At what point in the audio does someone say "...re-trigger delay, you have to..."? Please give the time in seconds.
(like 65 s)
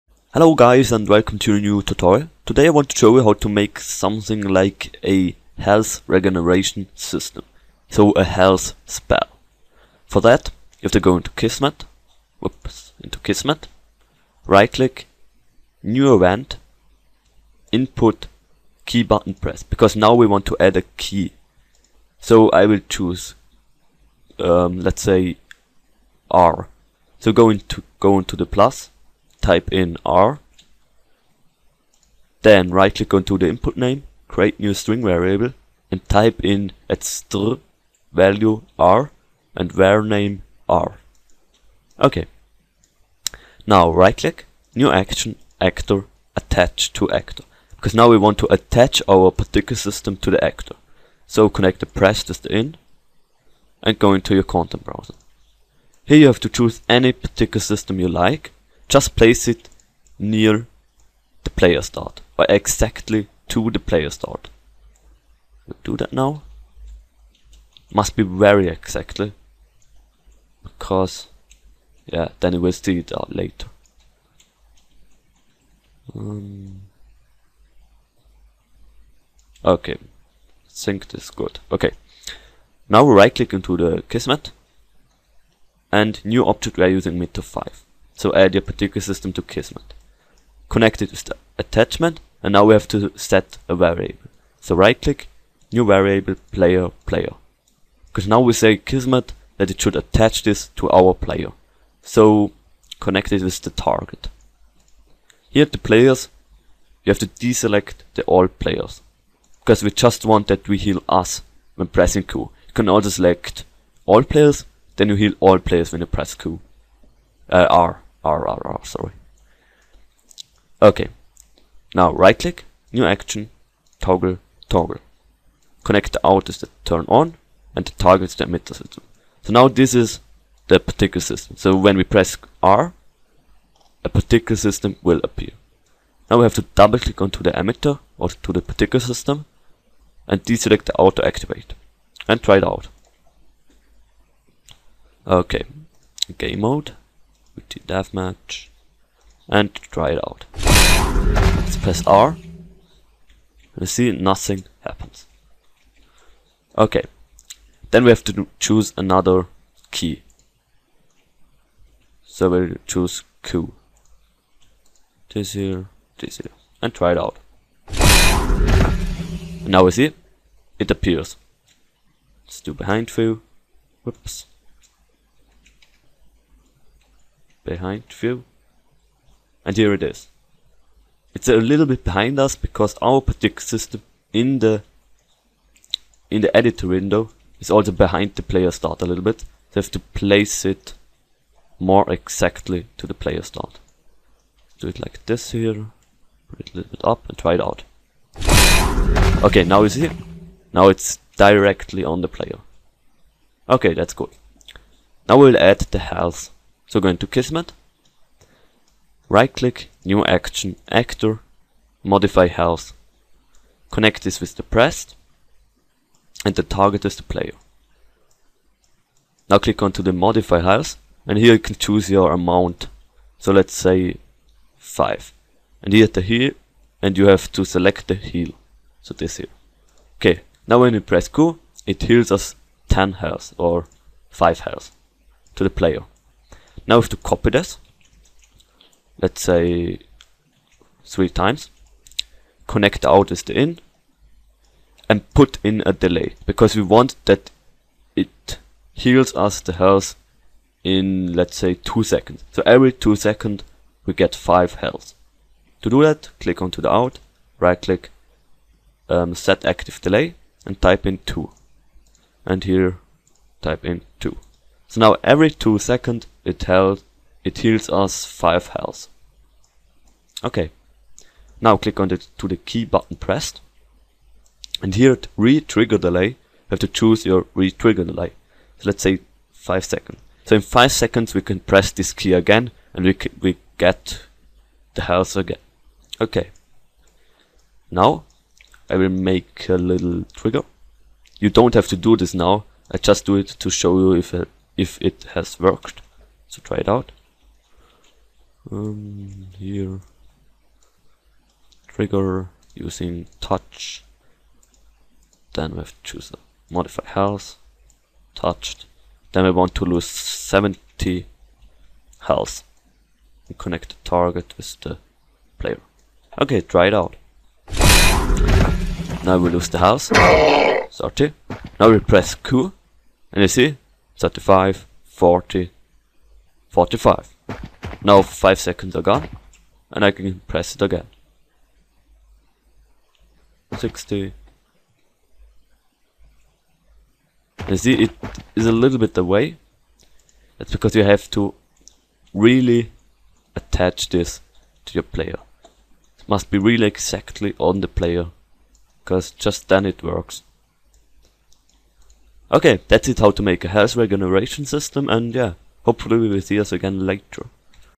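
275 s.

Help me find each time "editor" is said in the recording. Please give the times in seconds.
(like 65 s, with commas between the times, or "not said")
186 s.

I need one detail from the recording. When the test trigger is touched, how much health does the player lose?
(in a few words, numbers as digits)
70.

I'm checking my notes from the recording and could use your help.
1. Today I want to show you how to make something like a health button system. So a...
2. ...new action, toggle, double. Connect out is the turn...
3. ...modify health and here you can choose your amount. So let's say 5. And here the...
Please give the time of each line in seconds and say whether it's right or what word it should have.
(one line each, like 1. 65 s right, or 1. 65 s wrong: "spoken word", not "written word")
1. 2 s wrong: "regeneration", not "button"
2. 122 s wrong: "toggle", not "double"
3. 220 s right.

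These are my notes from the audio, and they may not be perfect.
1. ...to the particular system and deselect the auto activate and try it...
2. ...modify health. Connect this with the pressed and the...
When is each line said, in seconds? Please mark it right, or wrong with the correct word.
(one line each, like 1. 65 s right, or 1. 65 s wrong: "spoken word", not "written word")
1. 138 s right
2. 212 s right.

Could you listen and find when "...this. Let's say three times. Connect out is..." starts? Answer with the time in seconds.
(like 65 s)
237 s.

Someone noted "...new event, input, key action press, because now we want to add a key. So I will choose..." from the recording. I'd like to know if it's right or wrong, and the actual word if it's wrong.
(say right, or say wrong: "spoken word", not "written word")
wrong: "button", not "action".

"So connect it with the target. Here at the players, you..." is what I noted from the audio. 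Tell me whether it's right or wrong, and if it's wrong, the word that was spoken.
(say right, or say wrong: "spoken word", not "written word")
right.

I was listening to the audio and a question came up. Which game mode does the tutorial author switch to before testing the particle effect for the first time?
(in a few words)
Deathmatch.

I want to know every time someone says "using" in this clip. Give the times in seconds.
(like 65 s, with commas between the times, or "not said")
86 s, 302 s.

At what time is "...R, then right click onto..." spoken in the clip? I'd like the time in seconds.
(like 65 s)
30 s.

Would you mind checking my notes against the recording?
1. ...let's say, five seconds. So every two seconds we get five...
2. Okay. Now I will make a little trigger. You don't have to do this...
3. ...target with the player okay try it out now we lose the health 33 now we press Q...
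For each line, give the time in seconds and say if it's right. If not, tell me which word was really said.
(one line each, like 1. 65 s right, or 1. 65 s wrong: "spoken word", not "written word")
1. 251 s wrong: "two", not "five"
2. 286 s right
3. 314 s wrong: "30", not "33".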